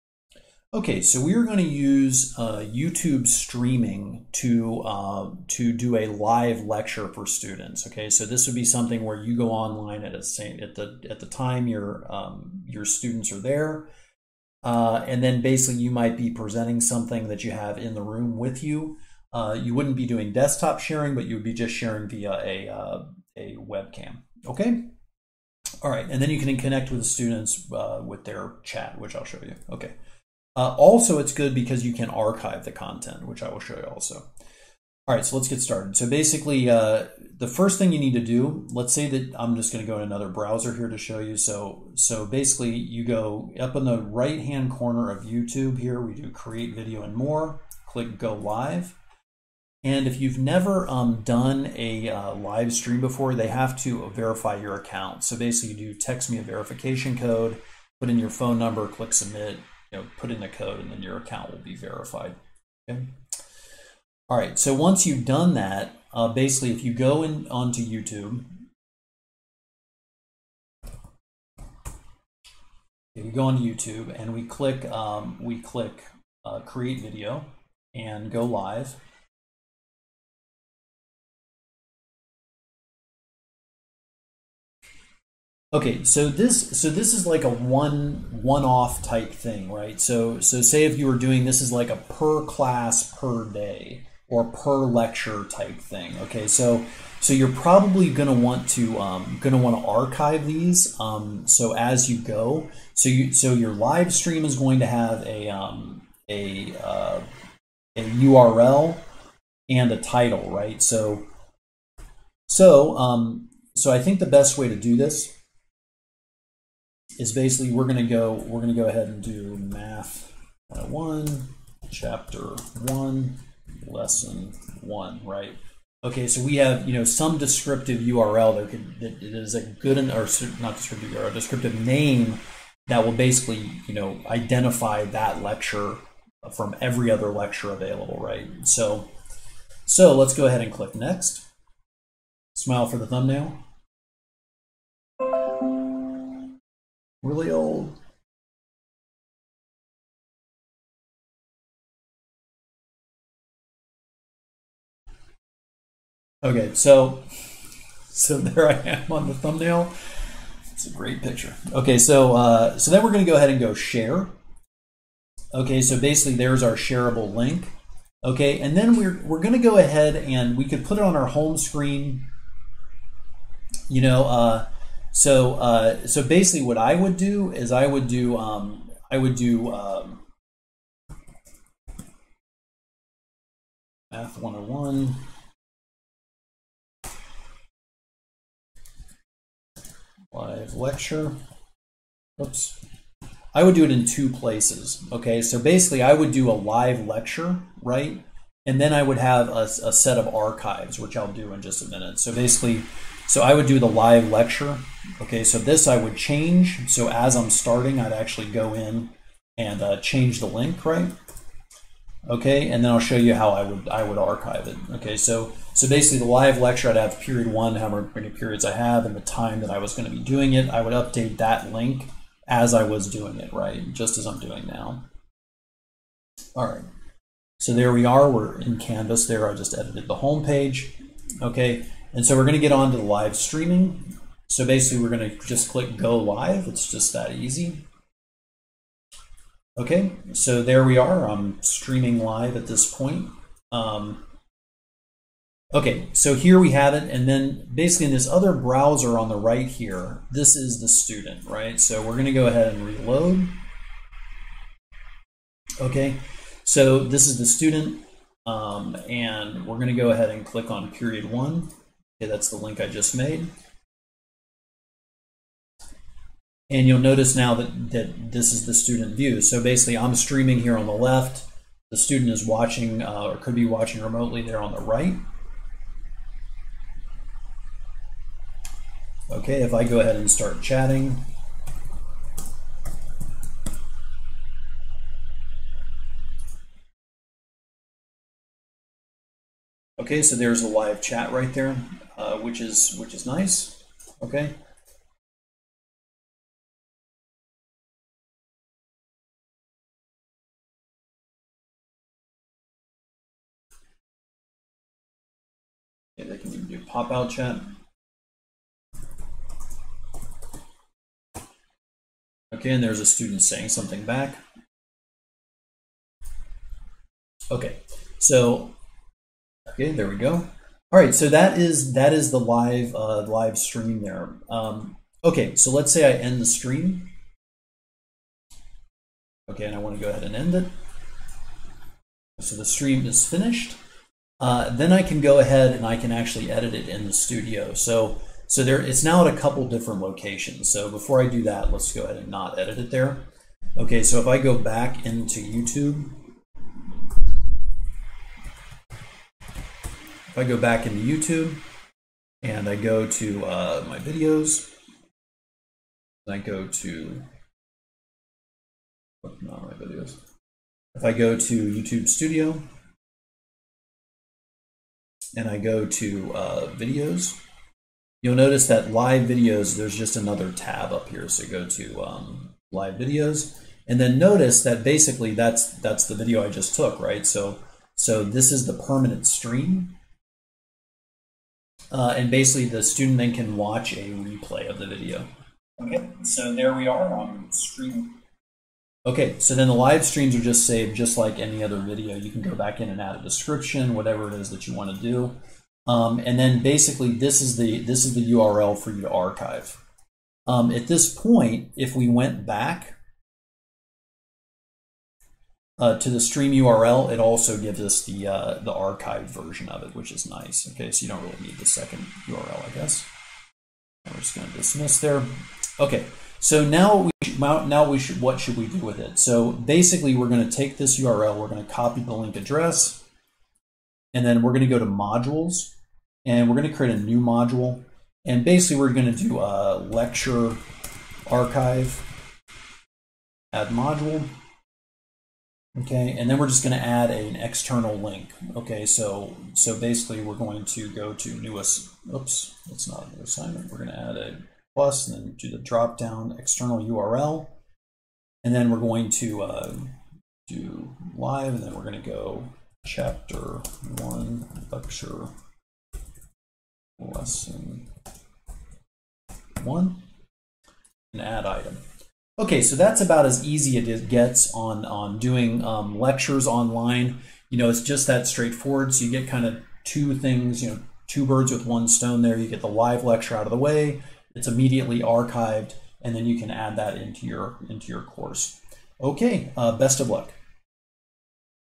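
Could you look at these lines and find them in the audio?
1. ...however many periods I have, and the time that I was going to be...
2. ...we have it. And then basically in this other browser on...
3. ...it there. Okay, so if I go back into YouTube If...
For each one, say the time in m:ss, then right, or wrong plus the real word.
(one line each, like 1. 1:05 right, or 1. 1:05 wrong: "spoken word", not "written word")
1. 3:37 right
2. 4:06 right
3. 5:42 right.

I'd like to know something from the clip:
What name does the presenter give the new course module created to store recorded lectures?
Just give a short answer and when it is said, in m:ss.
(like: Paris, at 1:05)
lecture archive, at 7:09.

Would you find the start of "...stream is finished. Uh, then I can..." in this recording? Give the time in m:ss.
5:32.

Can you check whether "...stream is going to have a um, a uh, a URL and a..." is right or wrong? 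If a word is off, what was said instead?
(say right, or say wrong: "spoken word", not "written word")
right.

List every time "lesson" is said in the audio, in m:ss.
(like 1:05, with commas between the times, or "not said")
2:03, 7:36.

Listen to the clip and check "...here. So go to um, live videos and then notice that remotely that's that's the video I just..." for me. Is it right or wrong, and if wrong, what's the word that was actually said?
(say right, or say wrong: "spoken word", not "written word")
wrong: "basically", not "remotely".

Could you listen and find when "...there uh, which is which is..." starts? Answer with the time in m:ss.
4:51.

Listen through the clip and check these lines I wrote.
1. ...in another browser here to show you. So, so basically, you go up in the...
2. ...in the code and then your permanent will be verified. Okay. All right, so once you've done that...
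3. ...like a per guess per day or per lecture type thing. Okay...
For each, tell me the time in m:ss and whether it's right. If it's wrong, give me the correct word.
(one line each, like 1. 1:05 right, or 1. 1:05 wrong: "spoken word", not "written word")
1. 0:39 right
2. 1:00 wrong: "account", not "permanent"
3. 1:31 wrong: "class", not "guess".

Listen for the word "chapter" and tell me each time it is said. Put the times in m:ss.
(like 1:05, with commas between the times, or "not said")
2:01, 7:32.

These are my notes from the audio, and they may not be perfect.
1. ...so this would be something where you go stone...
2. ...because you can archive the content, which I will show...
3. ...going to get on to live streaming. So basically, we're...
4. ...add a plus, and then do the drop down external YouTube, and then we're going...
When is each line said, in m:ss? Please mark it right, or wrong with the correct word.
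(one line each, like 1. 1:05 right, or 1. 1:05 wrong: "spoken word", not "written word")
1. 0:08 wrong: "online", not "stone"
2. 0:31 right
3. 3:52 right
4. 7:23 wrong: "URL", not "YouTube".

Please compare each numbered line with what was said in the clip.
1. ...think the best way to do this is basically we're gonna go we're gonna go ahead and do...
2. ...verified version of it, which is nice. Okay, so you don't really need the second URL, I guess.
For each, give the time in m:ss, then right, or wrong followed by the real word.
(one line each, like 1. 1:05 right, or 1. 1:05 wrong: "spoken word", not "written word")
1. 1:53 right
2. 6:48 wrong: "archived", not "verified".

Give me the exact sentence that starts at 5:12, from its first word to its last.
Okay, and there's a student saying something back.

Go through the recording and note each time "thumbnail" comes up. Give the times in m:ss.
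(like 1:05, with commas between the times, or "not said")
2:23, 2:39.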